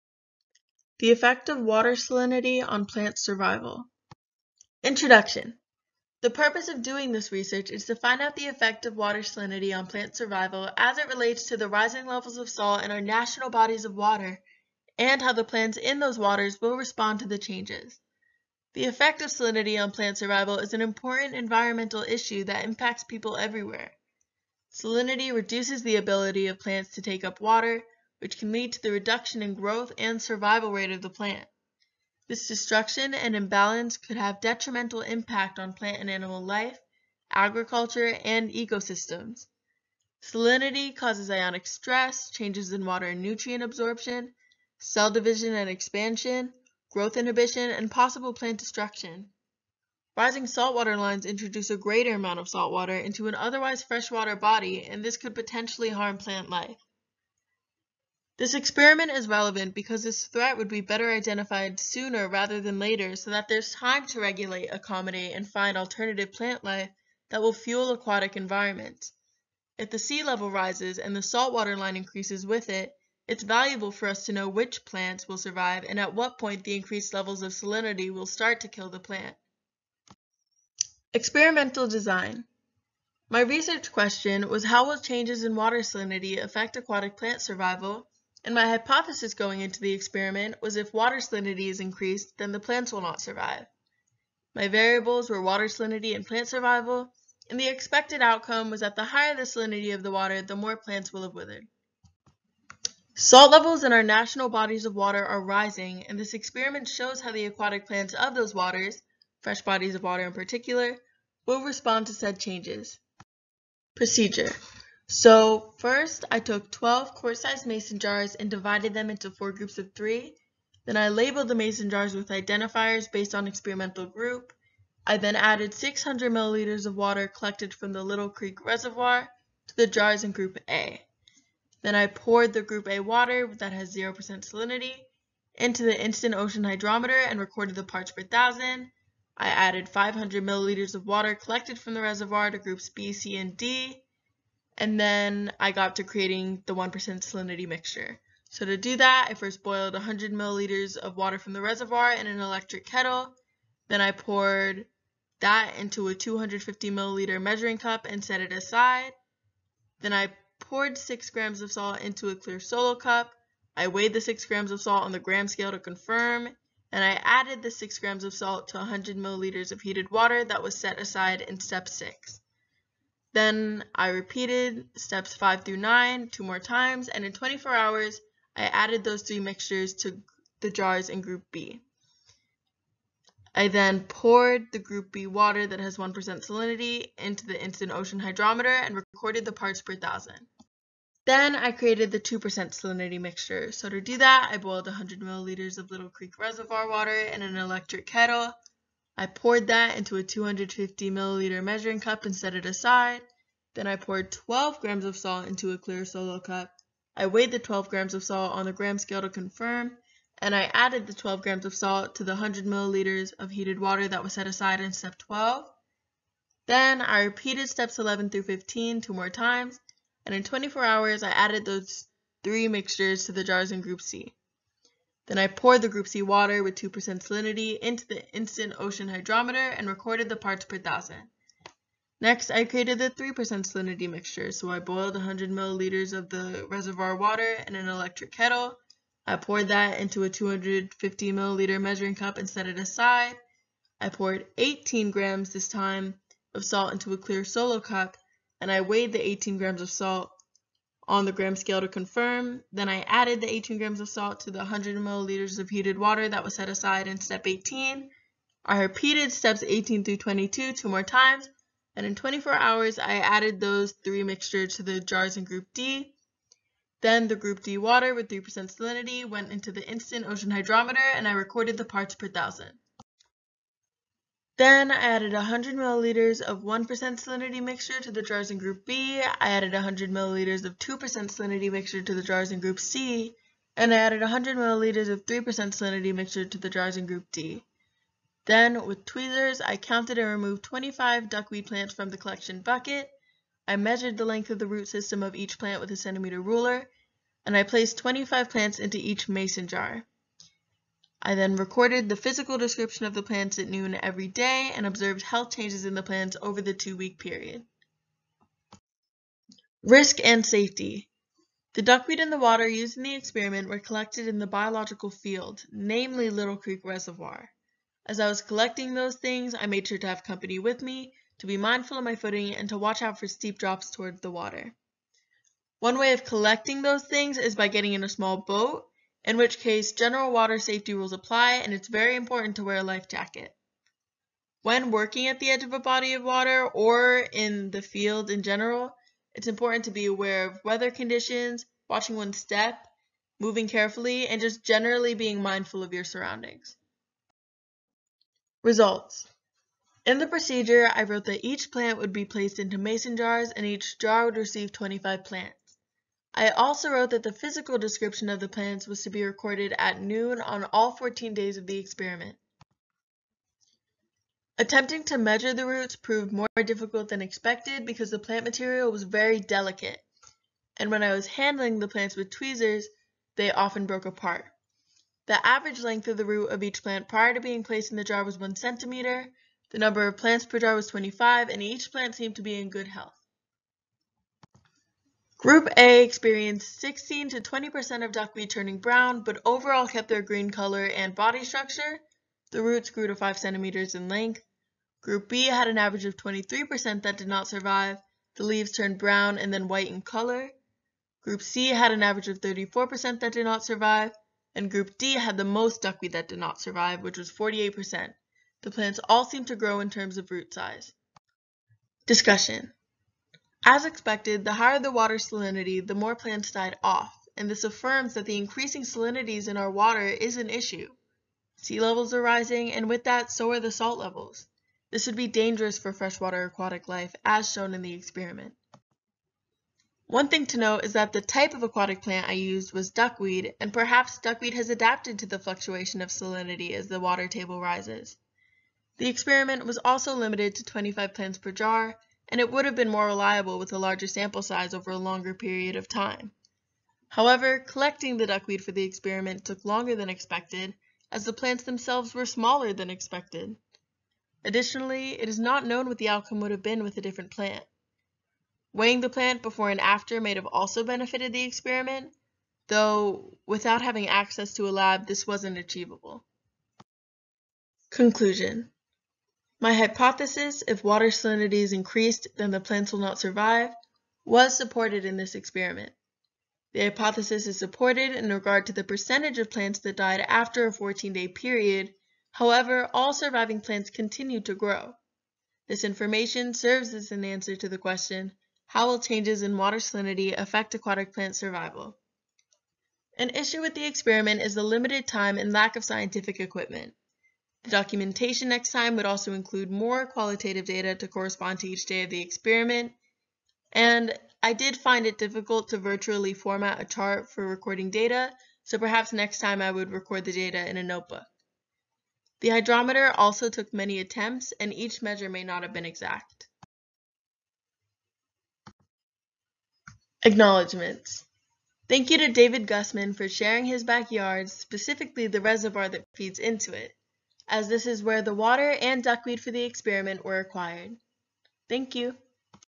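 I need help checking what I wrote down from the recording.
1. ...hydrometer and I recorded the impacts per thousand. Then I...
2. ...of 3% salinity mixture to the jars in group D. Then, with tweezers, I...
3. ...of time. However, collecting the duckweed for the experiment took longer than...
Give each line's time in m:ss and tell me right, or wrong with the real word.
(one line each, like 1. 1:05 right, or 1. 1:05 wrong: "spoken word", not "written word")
1. 4:30 wrong: "parts", not "impacts"
2. 4:45 right
3. 7:25 right.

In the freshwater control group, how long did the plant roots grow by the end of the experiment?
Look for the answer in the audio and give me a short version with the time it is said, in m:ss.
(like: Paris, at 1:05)
5 centimeters, at 6:33.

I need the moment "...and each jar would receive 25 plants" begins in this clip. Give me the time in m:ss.
5:53.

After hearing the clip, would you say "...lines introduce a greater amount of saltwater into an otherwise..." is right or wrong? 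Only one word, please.
right.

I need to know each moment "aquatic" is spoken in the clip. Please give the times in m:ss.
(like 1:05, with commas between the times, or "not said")
1:07, 1:26, 1:47, 7:06, 7:11, 8:10.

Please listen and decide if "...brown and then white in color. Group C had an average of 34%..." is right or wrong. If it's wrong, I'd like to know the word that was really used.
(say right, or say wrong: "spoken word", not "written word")
right.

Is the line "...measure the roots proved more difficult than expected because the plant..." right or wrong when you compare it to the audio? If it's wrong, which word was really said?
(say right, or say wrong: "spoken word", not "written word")
right.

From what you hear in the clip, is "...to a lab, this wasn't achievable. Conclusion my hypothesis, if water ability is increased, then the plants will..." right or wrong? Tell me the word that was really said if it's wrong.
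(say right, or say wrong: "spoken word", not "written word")
wrong: "salinity", not "ability".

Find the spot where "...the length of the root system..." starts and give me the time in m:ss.
4:54.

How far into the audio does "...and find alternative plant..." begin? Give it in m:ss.
1:05.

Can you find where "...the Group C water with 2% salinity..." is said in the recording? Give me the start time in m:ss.
3:45.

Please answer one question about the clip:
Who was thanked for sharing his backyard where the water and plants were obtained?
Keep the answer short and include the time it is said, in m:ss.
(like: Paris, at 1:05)
David Gussman, at 8:42.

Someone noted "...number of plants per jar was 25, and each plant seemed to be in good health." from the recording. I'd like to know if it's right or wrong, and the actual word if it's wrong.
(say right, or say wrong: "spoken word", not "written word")
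right.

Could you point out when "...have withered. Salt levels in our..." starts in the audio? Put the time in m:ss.
1:41.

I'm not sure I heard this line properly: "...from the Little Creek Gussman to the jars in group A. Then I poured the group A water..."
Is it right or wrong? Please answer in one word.
wrong.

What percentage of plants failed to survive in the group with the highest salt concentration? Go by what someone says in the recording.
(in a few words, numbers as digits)
48%.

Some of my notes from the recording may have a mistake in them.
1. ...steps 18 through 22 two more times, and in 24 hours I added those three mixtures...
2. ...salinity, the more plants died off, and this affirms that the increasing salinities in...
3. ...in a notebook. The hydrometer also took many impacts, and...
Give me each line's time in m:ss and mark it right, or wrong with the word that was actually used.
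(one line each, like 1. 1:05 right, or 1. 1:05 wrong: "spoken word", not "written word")
1. 4:19 right
2. 6:55 right
3. 8:30 wrong: "attempts", not "impacts".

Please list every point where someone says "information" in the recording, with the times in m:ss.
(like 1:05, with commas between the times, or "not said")
8:05.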